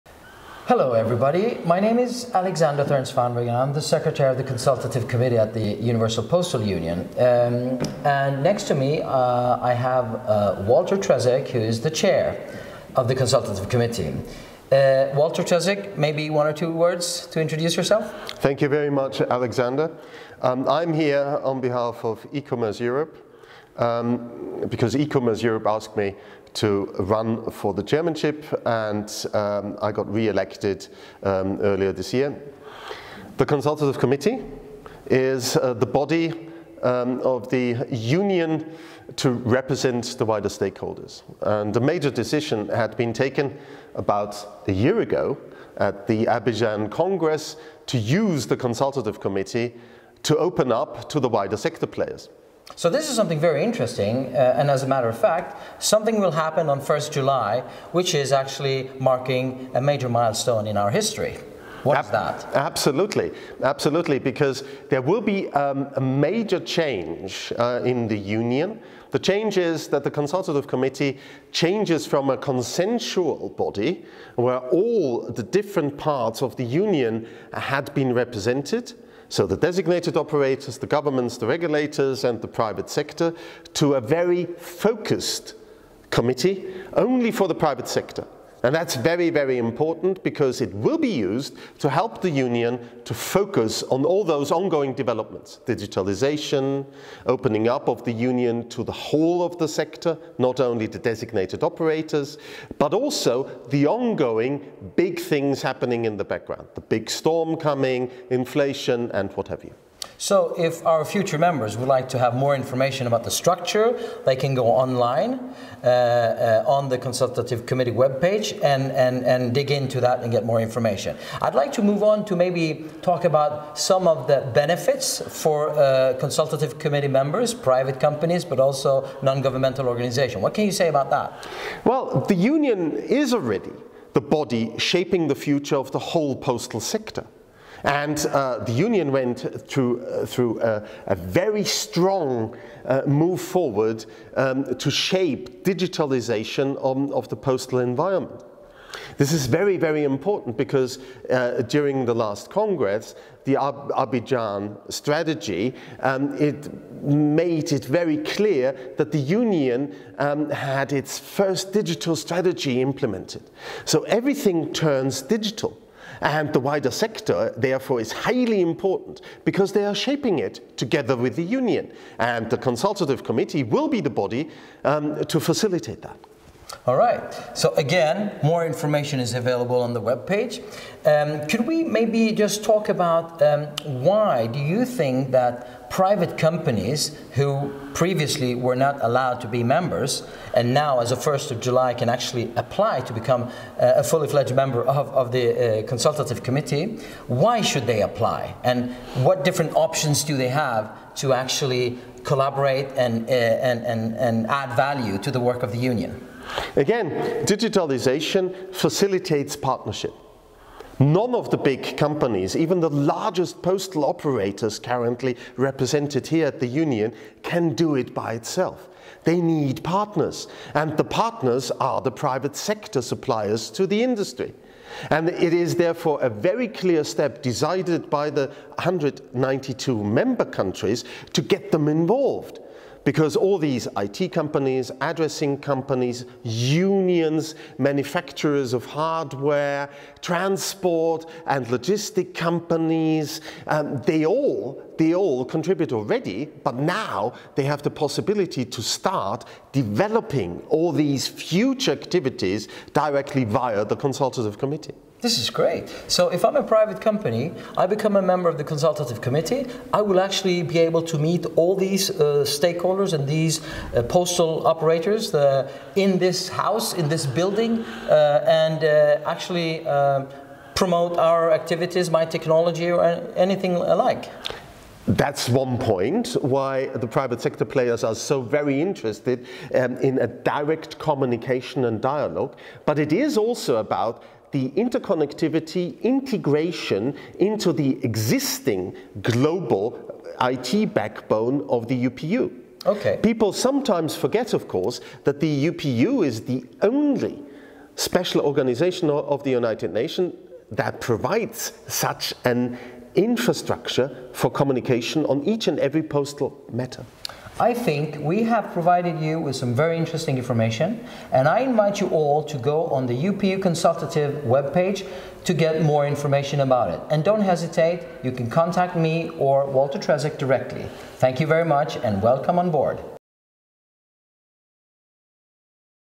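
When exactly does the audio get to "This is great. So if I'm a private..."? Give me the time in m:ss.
4:15.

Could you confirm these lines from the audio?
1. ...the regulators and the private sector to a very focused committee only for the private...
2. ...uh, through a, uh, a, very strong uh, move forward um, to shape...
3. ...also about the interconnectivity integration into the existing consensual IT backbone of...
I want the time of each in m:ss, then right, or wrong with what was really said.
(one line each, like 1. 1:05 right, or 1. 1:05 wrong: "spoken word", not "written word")
1. 1:21 right
2. 2:20 right
3. 4:43 wrong: "global", not "consensual".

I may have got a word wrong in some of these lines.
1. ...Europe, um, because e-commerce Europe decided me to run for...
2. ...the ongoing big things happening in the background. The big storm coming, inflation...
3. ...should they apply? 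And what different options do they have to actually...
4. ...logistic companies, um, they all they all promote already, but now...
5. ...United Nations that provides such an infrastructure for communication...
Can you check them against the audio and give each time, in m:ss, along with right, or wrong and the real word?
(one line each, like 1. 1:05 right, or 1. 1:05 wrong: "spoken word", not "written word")
1. 0:22 wrong: "asked", not "decided"
2. 1:43 right
3. 3:17 right
4. 4:01 wrong: "contribute", not "promote"
5. 4:59 right.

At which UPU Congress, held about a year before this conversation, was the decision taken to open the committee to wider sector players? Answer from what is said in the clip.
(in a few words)
Abidjan Congress.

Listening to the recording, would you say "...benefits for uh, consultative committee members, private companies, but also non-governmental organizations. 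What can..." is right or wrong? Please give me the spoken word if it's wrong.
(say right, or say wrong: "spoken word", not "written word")
right.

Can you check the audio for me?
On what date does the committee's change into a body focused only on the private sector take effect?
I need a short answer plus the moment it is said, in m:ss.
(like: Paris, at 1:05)
1 July, at 0:56.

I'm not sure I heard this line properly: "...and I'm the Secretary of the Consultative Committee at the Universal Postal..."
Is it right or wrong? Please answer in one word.
right.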